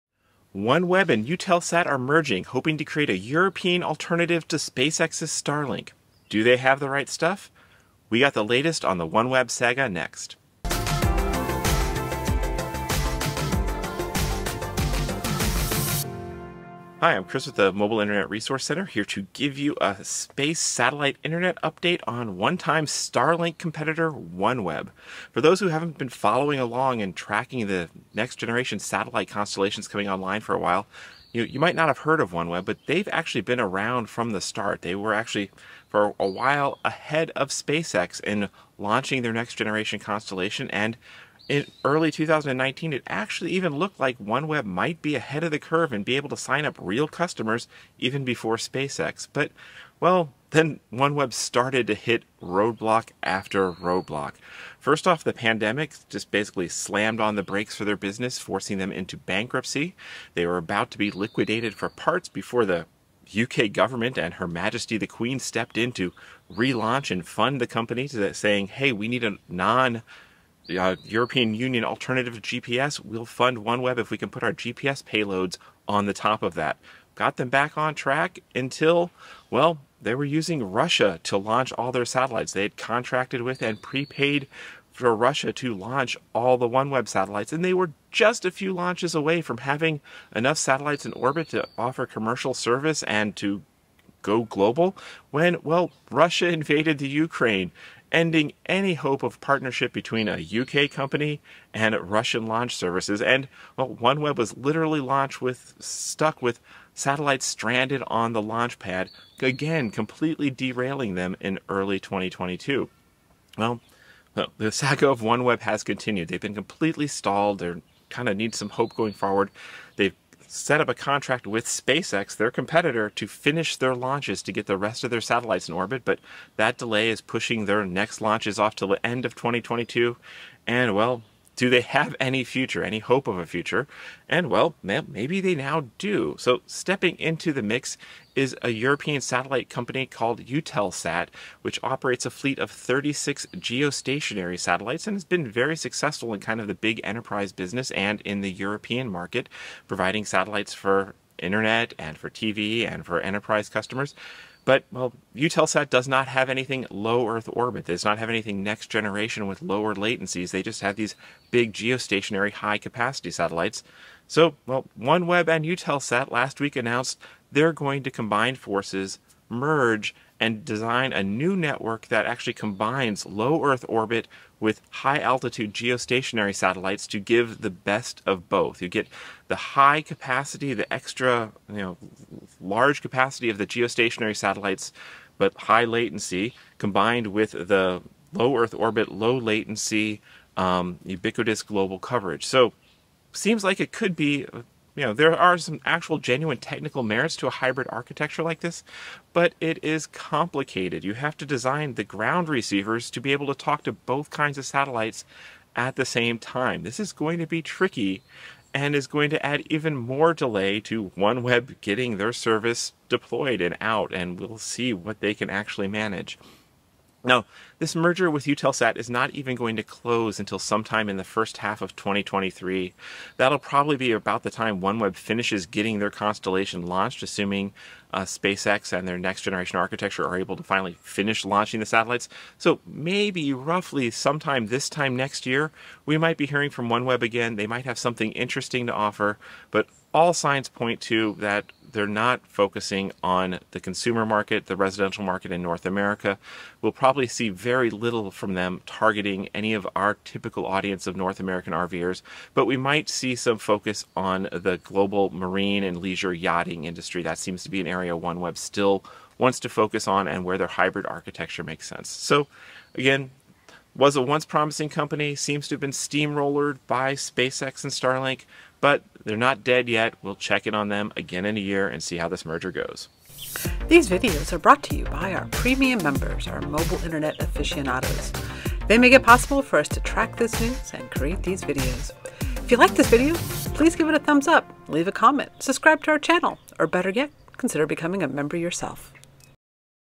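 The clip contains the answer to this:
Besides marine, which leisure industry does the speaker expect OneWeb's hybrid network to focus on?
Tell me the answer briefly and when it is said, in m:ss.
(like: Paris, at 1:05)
yachting, at 4:16.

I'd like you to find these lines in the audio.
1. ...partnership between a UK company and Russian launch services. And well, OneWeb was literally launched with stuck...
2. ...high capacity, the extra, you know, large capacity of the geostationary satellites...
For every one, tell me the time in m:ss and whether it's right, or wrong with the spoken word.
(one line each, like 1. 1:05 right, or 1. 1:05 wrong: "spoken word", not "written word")
1. 1:39 right
2. 2:59 right.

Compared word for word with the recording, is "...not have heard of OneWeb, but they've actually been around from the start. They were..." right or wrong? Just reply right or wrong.
right.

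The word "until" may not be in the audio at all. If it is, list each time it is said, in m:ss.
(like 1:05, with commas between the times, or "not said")
1:18, 3:40.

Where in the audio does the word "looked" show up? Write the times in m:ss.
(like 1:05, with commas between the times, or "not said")
0:43.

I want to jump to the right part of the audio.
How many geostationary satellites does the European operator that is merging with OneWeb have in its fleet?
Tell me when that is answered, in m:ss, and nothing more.
2:22.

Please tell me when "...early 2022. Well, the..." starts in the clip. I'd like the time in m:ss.
1:51.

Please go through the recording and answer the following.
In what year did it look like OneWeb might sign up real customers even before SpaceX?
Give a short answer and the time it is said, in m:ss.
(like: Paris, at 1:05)
2019, at 0:42.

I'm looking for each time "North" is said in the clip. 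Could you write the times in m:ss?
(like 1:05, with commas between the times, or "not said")
4:05, 4:11.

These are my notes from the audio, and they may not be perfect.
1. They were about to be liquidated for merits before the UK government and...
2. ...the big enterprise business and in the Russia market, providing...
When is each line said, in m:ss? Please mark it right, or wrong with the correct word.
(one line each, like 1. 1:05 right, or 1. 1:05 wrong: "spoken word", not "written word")
1. 1:00 wrong: "parts", not "merits"
2. 2:26 wrong: "European", not "Russia".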